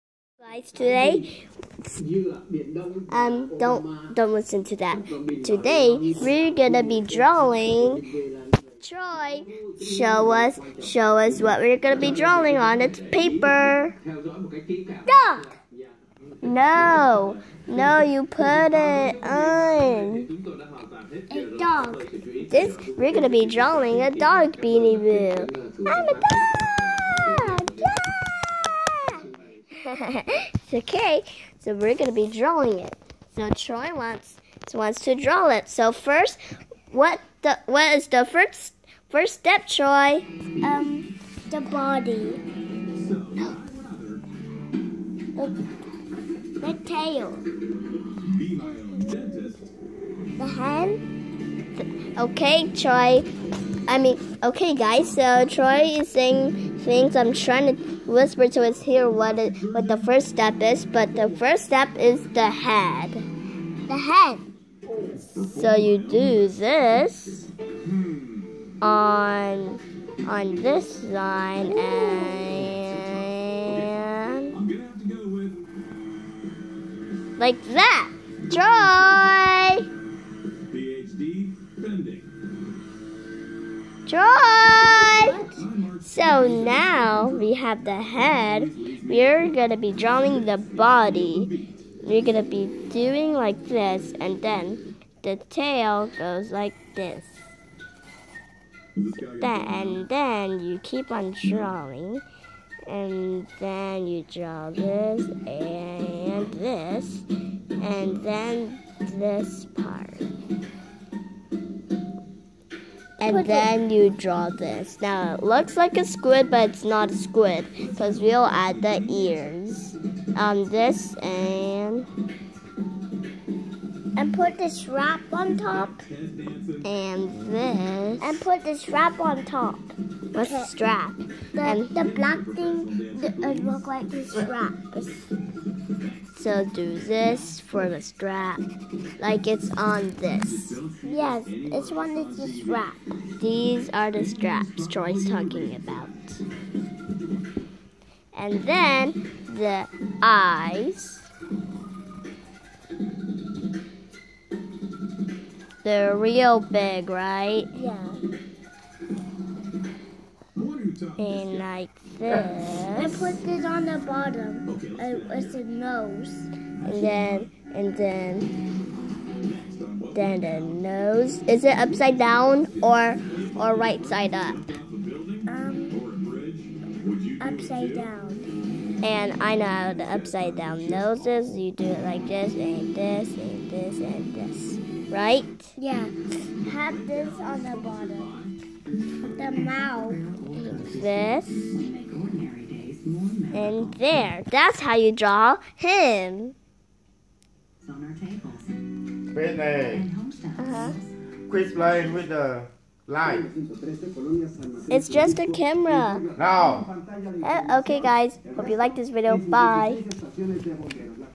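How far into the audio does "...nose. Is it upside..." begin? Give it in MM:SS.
02:50.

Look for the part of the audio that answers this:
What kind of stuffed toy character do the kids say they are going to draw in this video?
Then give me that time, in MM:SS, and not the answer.
00:24.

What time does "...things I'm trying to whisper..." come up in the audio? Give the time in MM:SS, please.
00:56.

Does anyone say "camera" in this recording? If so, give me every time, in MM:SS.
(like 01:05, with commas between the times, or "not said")
03:25.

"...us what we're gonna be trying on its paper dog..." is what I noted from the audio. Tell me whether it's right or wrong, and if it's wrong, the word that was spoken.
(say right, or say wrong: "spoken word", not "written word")
wrong: "drawing", not "trying".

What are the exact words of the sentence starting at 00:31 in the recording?
So we're gonna be drawing it.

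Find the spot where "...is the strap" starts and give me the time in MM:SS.
02:22.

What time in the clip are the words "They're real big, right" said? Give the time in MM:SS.
02:35.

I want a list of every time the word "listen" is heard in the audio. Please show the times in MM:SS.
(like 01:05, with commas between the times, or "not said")
00:04.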